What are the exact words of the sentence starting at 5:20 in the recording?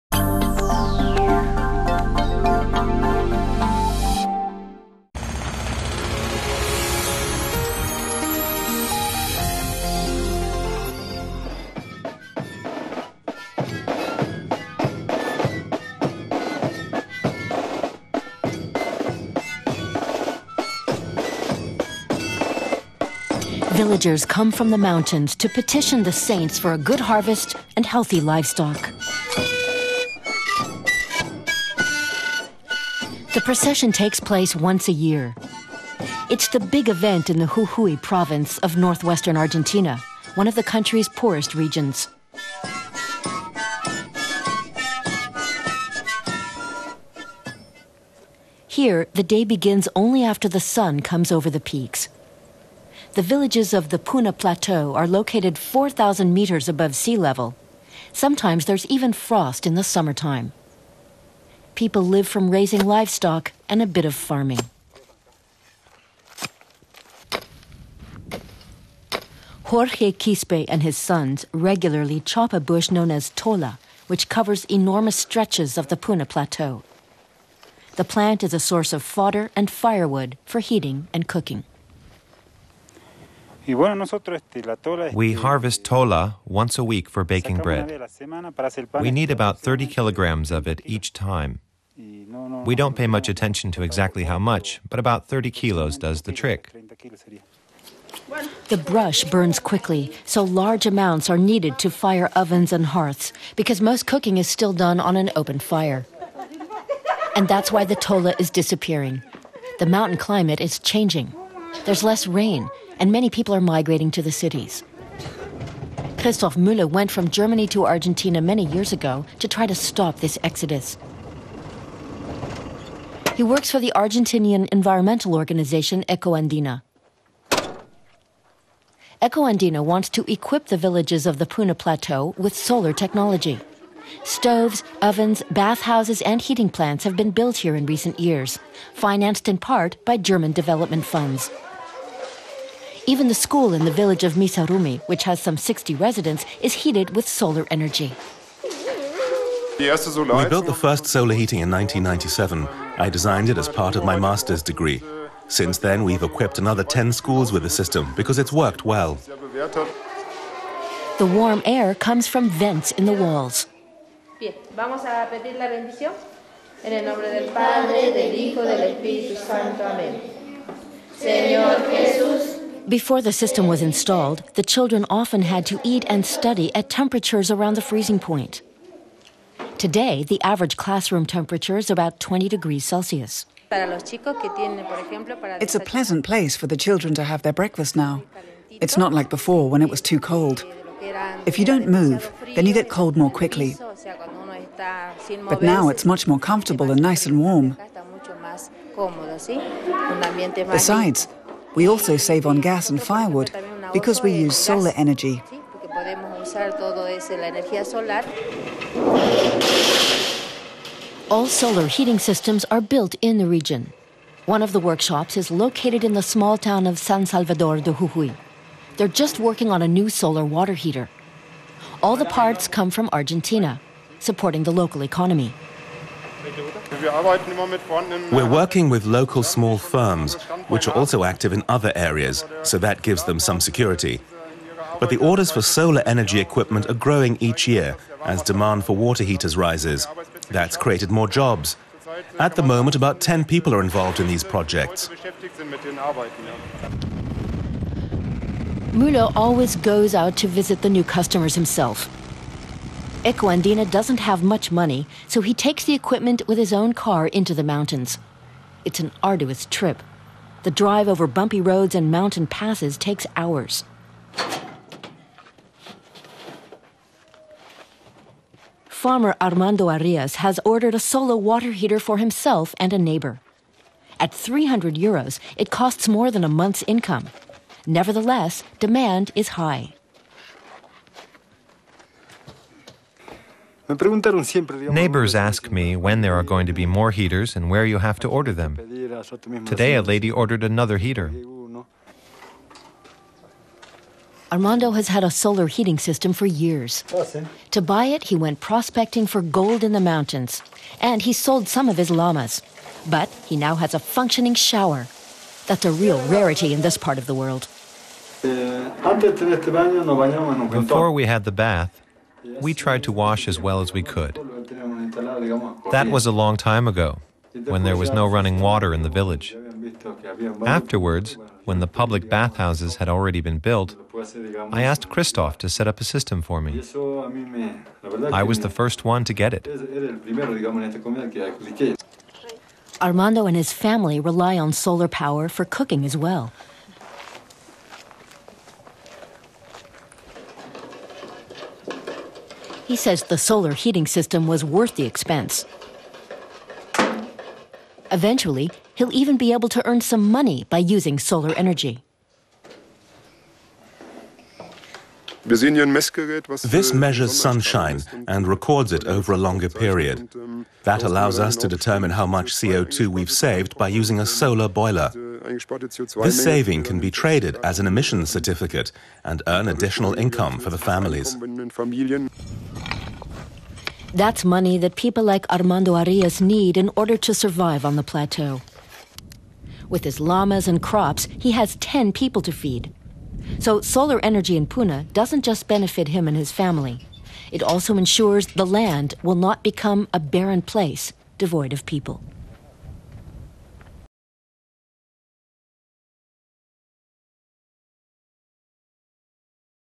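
Afterwards, when the public bathhouses had already been built, I asked Christoph to set up a system for me.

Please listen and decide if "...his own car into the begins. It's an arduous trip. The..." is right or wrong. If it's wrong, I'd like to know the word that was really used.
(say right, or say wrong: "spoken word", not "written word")
wrong: "mountains", not "begins".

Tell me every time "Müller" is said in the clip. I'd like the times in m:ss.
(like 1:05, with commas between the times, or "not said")
1:56, 4:08.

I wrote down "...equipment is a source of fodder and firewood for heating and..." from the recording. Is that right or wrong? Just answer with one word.
wrong.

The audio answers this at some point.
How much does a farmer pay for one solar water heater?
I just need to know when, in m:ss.
4:34.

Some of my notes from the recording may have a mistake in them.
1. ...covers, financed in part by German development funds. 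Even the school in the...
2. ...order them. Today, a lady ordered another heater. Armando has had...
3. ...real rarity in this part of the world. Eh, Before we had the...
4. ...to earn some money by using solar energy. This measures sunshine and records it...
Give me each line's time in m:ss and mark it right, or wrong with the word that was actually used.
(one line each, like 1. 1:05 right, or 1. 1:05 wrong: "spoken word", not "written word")
1. 2:18 wrong: "years", not "covers"
2. 4:48 right
3. 5:05 right
4. 5:49 right.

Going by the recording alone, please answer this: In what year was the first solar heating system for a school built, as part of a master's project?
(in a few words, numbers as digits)
1997.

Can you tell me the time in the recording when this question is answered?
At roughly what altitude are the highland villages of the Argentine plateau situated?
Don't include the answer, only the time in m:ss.
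0:55.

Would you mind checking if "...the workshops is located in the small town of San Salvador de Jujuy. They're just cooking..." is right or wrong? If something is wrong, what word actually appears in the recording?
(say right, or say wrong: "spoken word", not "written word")
wrong: "working", not "cooking".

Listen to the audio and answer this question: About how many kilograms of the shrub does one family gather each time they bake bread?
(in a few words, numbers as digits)
30 kilograms.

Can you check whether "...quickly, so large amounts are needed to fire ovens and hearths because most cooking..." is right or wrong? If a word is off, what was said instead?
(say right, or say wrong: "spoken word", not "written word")
right.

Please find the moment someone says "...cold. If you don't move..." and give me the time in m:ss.
3:10.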